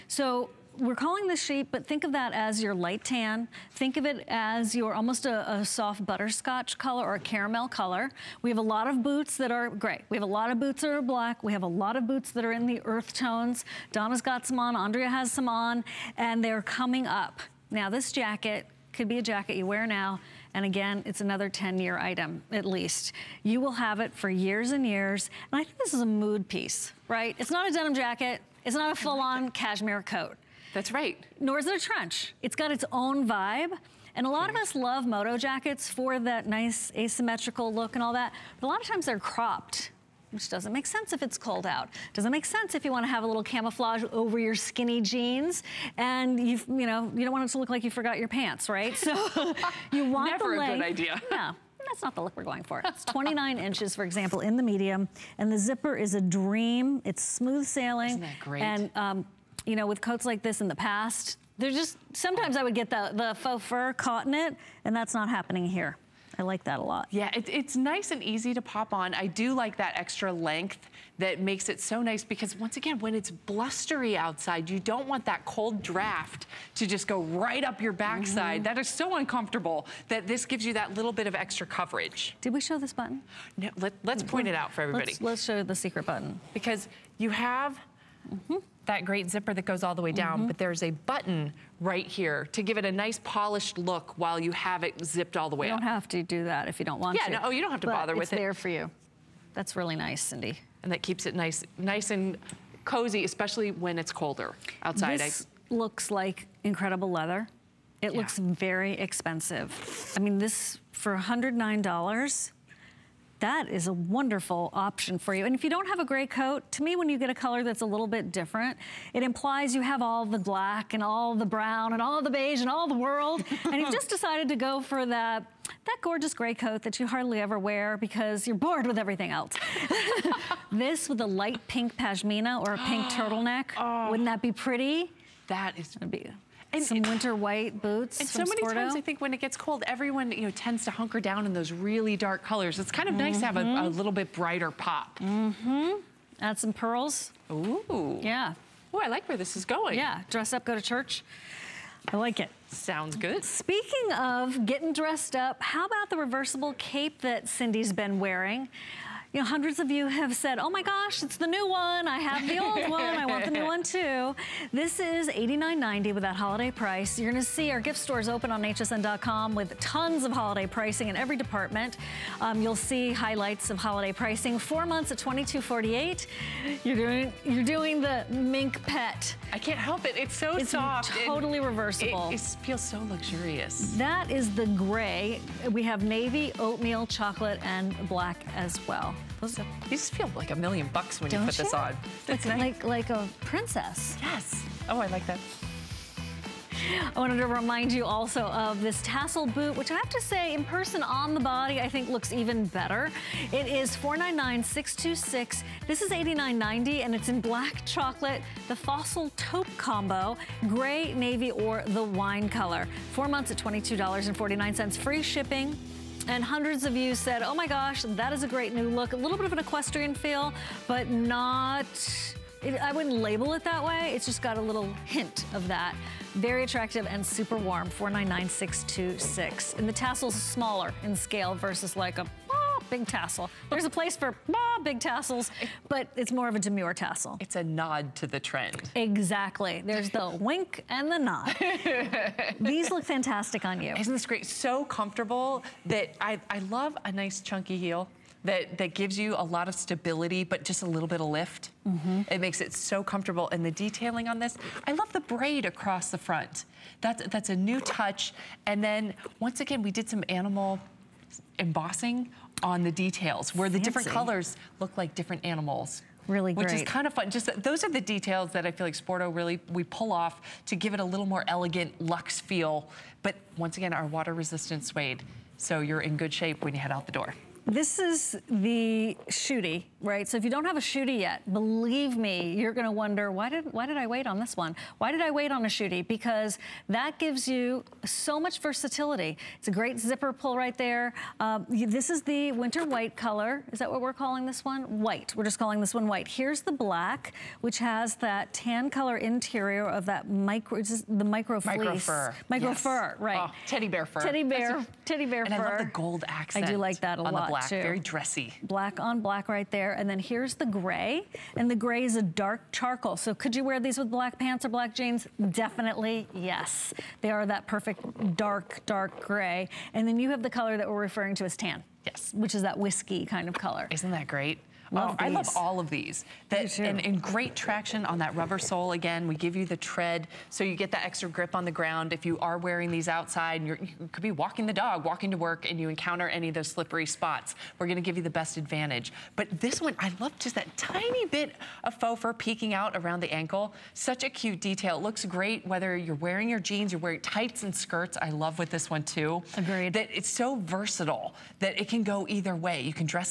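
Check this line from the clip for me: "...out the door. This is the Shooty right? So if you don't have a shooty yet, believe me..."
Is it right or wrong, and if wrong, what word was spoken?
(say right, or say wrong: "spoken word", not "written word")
right.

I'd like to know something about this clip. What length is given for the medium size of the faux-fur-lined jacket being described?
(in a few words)
29 inches.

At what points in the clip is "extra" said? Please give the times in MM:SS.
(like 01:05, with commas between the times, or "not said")
01:09, 01:21, 05:31.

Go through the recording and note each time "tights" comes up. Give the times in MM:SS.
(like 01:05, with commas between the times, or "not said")
05:47.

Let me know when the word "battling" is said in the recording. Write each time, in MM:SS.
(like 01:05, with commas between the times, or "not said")
not said.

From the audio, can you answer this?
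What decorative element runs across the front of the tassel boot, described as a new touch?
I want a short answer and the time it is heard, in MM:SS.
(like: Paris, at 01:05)
braid, at 04:15.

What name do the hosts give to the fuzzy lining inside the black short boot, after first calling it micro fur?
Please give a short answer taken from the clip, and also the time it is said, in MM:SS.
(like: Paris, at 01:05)
teddy bear fur, at 05:03.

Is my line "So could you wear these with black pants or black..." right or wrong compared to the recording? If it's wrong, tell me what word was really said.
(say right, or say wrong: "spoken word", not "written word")
right.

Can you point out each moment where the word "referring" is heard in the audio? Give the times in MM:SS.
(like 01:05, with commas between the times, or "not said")
05:20.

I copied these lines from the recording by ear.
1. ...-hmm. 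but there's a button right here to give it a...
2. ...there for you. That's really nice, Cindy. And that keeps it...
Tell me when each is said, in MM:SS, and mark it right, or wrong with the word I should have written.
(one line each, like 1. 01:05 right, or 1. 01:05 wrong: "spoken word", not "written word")
1. 01:30 right
2. 01:38 right.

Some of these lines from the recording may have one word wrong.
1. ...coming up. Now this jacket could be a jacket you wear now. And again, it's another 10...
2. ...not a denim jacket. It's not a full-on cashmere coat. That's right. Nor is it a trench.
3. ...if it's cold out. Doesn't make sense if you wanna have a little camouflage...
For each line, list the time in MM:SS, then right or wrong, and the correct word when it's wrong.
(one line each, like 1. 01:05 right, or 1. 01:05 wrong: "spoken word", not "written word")
1. 00:16 right
2. 00:27 right
3. 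00:41 right.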